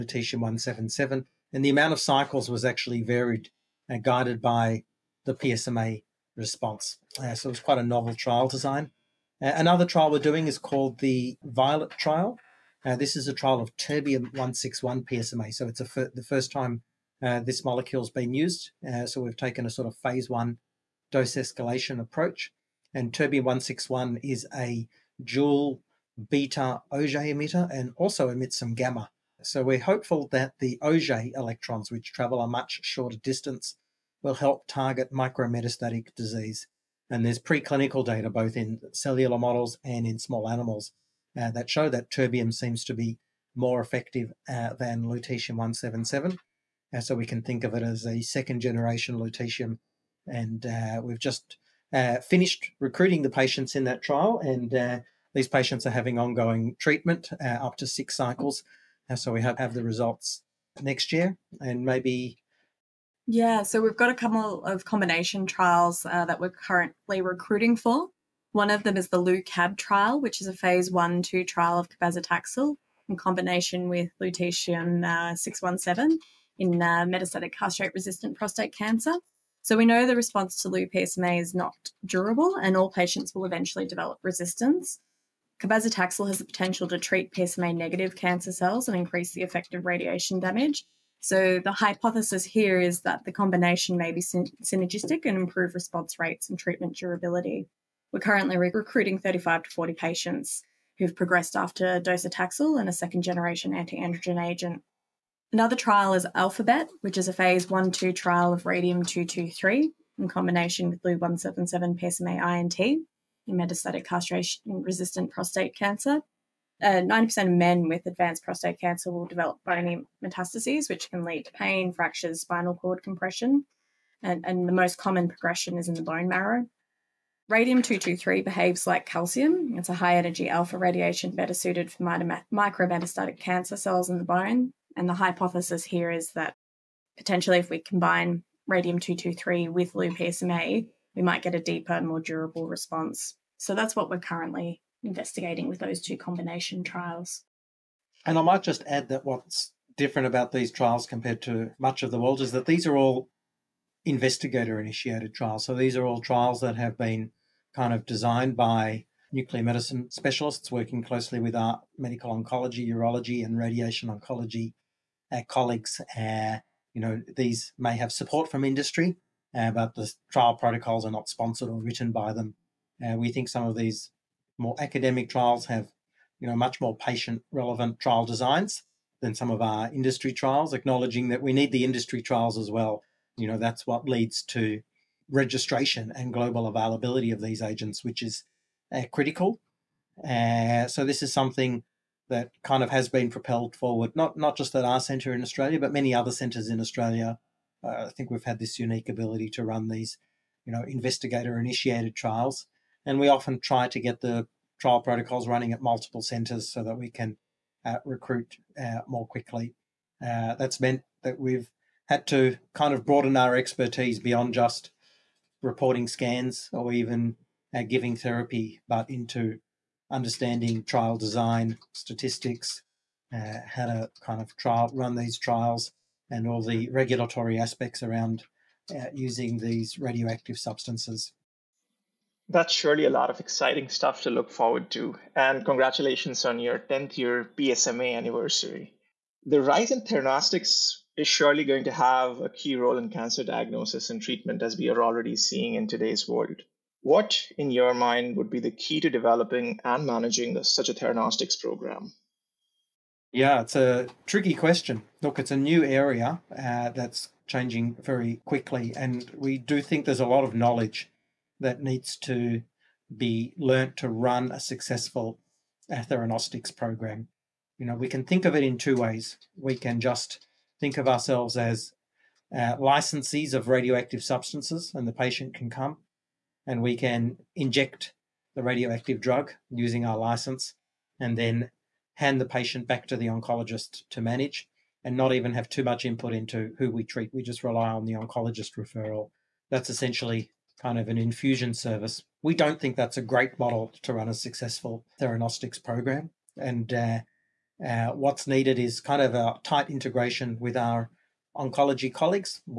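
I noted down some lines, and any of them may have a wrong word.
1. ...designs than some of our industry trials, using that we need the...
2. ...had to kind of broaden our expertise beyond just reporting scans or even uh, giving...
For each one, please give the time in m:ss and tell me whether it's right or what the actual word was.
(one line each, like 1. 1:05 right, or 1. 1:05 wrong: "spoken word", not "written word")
1. 2:58 wrong: "acknowledging", not "using"
2. 3:32 right.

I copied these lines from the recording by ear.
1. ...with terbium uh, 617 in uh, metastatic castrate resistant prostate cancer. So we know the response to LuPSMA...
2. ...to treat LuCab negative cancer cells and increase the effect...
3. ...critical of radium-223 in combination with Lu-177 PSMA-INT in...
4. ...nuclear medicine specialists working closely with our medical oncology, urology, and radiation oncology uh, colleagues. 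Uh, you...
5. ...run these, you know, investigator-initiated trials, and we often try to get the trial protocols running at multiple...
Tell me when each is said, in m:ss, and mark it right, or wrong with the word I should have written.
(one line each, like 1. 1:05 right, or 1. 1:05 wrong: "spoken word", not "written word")
1. 1:13 wrong: "lutetium", not "terbium"
2. 1:26 wrong: "PSMA", not "LuCab"
3. 1:48 wrong: "trial", not "critical"
4. 2:39 right
5. 3:19 right.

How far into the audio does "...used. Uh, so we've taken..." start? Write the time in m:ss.
0:18.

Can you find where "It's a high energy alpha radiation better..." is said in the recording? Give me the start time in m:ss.
2:09.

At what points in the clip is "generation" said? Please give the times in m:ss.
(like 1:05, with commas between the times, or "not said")
0:48, 1:43.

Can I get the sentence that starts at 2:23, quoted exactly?
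So that's what we're currently investigating with those two combination trials.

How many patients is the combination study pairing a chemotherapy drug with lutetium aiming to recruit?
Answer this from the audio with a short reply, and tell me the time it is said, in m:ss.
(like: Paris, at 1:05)
35 to 40, at 1:39.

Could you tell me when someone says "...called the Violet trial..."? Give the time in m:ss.
0:10.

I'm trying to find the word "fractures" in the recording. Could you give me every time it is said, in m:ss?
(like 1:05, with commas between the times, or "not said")
2:01.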